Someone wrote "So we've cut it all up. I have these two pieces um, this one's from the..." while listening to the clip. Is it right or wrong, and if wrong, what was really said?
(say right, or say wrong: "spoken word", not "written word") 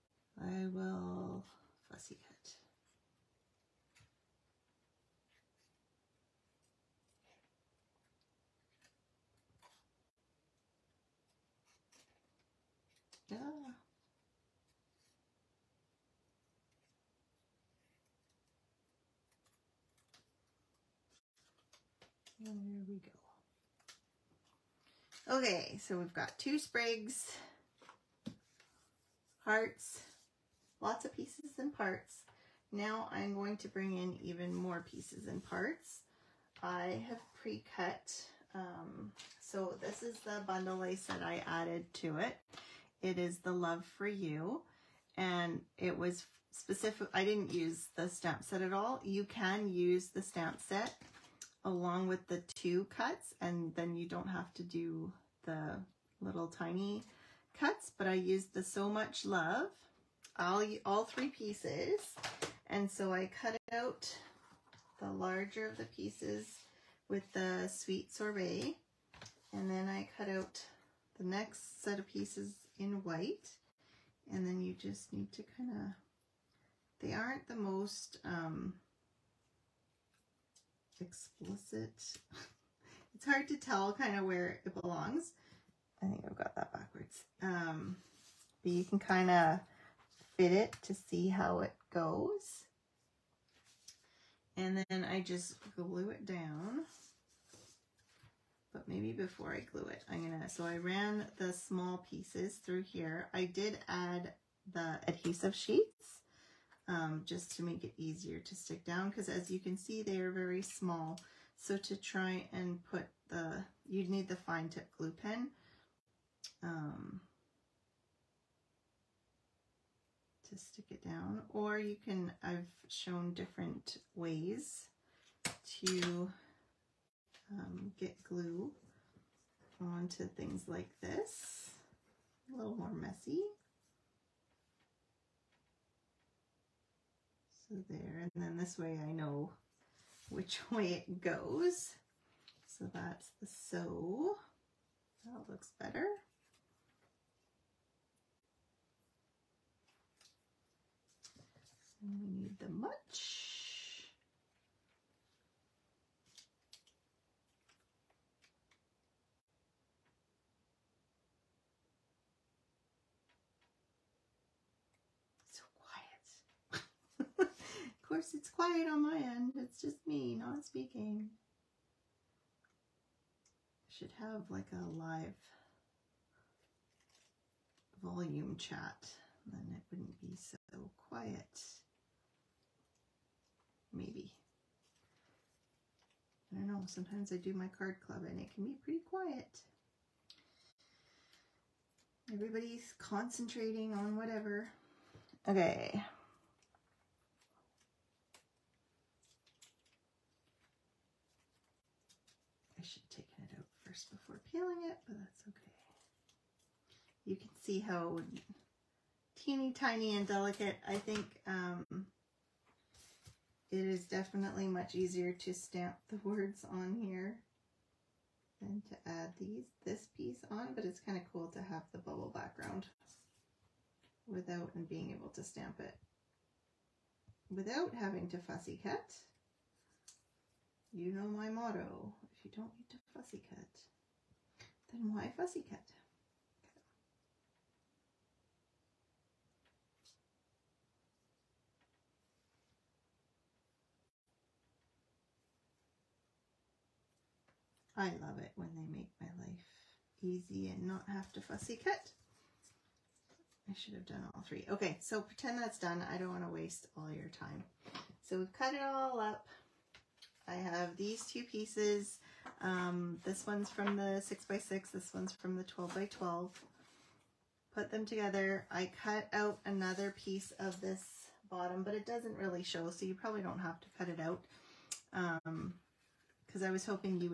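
right.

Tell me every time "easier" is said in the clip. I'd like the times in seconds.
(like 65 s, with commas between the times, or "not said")
107 s, 214 s.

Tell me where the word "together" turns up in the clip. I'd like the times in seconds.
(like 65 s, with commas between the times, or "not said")
268 s.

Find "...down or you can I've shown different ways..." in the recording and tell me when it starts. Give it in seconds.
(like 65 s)
121 s.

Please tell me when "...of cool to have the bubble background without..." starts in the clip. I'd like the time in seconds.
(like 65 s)
221 s.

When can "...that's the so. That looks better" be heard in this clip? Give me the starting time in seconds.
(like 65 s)
142 s.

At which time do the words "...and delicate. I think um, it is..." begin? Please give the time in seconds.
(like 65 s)
210 s.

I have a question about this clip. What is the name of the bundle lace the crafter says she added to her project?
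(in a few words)
Love For You.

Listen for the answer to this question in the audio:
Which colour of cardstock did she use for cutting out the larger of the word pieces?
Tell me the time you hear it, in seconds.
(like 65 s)
67 s.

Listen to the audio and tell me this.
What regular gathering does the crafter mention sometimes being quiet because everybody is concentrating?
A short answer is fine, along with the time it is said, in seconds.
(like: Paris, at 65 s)
card club, at 187 s.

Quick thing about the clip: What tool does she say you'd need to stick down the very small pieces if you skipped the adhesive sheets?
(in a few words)
fine tip glue pen.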